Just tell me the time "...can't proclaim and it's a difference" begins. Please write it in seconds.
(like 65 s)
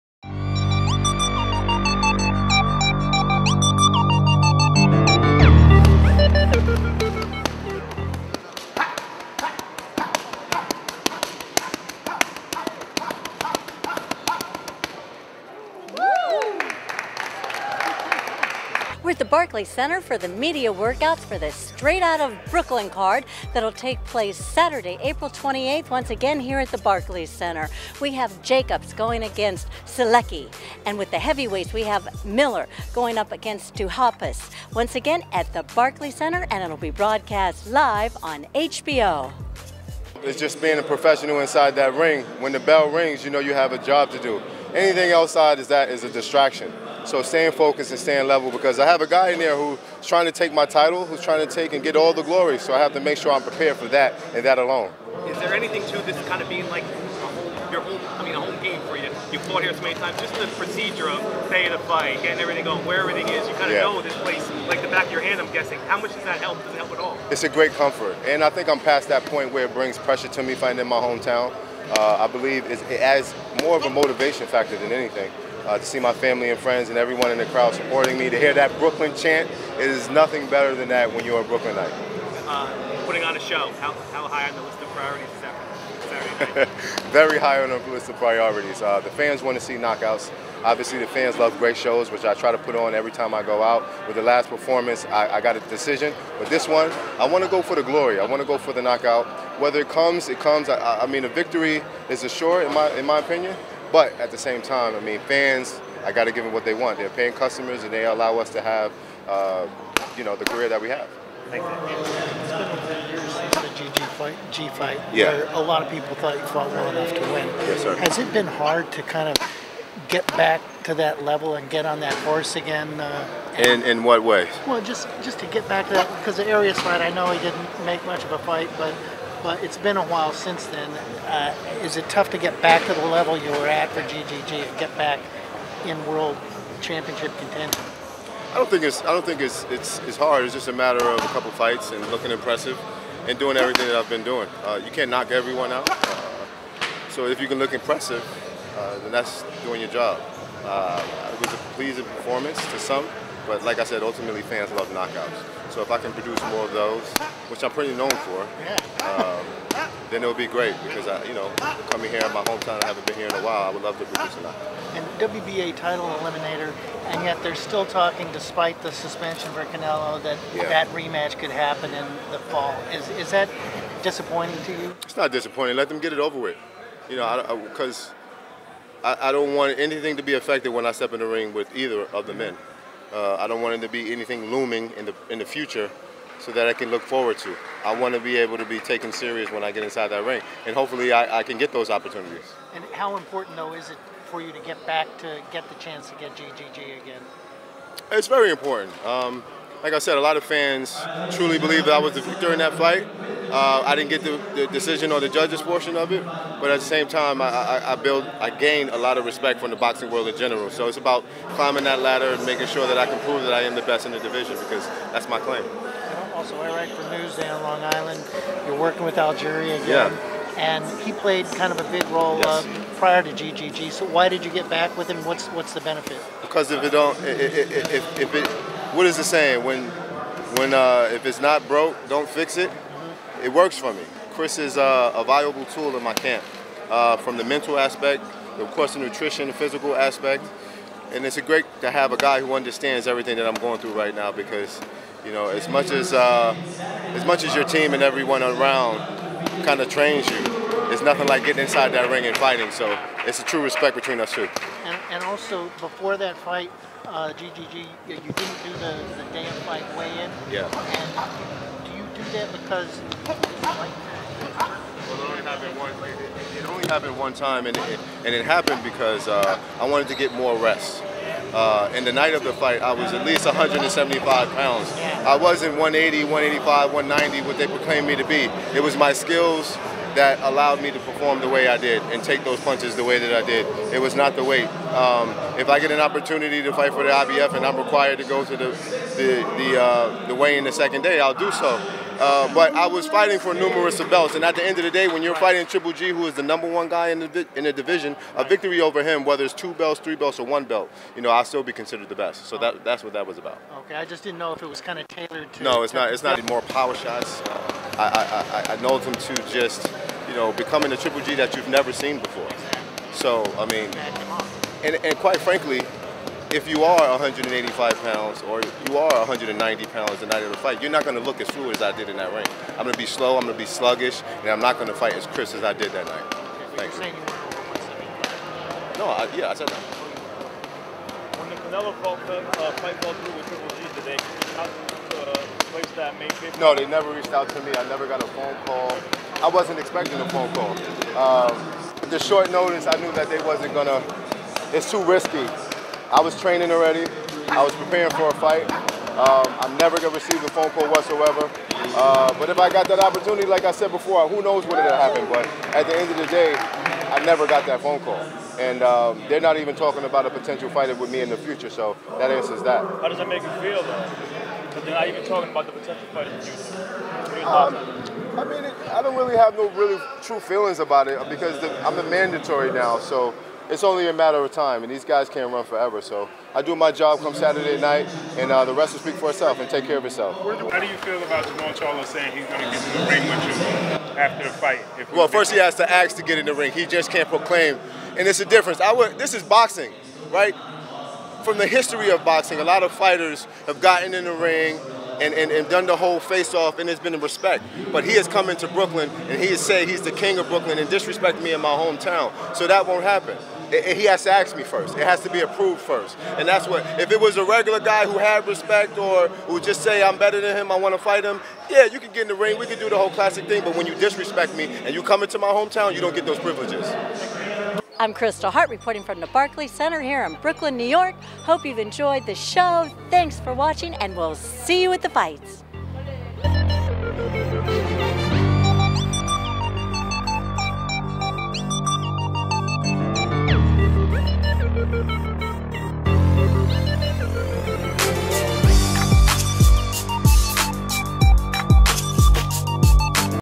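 387 s.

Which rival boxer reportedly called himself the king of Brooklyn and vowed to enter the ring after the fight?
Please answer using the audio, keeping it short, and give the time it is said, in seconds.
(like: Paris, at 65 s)
Jermall Charlo, at 381 s.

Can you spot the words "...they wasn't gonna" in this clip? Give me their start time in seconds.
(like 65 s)
343 s.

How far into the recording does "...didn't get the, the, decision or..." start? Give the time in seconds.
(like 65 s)
203 s.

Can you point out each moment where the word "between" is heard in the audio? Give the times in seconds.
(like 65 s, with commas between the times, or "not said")
253 s.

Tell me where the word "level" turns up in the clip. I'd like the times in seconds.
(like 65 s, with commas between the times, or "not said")
48 s, 121 s, 133 s.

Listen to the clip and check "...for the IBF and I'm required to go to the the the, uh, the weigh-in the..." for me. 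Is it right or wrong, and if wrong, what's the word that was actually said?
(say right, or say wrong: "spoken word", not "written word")
right.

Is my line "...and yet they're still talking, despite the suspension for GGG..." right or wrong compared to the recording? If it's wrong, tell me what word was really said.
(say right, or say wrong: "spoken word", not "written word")
wrong: "Canelo", not "GGG".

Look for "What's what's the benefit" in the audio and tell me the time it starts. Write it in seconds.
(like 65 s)
225 s.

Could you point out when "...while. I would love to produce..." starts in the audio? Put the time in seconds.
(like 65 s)
163 s.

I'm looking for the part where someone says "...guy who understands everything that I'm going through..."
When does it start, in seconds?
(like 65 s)
242 s.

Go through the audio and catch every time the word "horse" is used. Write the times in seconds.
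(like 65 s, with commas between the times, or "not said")
122 s.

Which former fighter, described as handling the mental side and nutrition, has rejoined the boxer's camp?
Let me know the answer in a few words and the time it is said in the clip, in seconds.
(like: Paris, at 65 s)
Algieri, at 219 s.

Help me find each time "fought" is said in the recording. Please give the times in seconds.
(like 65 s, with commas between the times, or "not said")
59 s, 116 s.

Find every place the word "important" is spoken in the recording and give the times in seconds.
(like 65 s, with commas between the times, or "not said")
193 s, 198 s.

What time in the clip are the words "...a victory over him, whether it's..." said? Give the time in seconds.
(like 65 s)
298 s.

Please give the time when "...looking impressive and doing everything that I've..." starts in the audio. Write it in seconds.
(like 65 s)
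142 s.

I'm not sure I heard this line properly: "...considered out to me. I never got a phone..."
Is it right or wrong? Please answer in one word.
wrong.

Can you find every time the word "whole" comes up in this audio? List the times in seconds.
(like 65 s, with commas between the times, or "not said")
395 s, 412 s.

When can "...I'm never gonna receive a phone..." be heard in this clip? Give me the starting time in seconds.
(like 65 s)
349 s.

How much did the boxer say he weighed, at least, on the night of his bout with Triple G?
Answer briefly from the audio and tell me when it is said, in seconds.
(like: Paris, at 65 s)
175 pounds, at 273 s.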